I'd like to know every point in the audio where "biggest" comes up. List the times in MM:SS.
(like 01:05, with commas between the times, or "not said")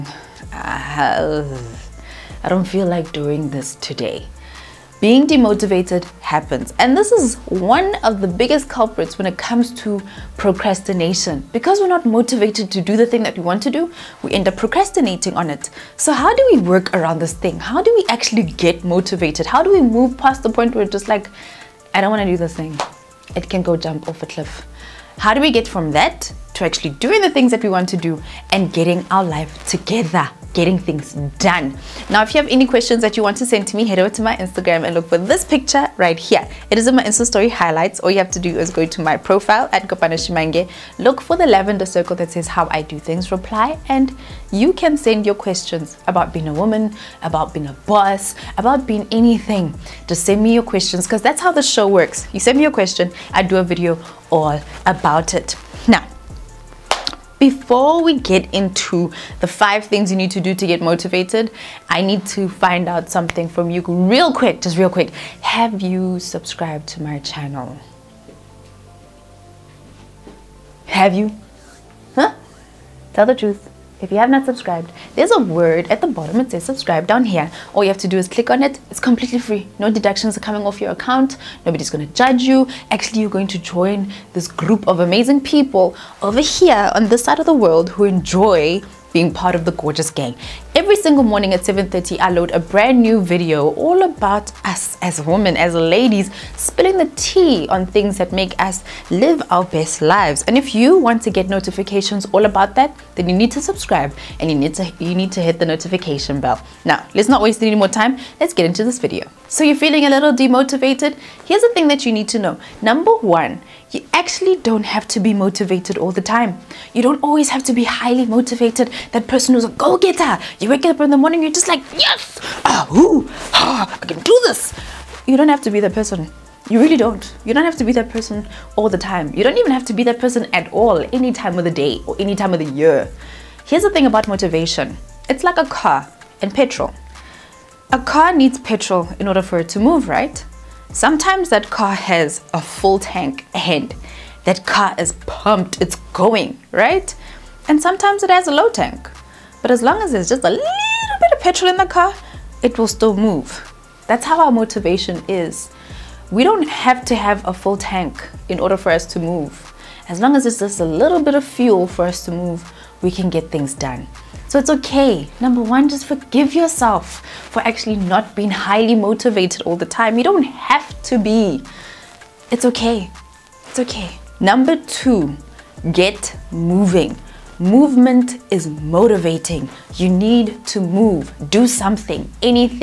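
00:08.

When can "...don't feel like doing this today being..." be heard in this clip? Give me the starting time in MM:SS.
00:02.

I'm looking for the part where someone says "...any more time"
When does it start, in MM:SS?
01:47.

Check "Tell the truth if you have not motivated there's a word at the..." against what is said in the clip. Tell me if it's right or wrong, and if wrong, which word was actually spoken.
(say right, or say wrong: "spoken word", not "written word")
wrong: "subscribed", not "motivated".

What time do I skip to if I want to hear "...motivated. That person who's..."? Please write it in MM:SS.
01:58.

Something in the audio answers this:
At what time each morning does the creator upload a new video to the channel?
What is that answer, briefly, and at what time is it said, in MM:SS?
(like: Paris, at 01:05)
7:30, at 01:31.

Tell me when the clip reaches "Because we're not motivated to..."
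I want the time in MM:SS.
00:11.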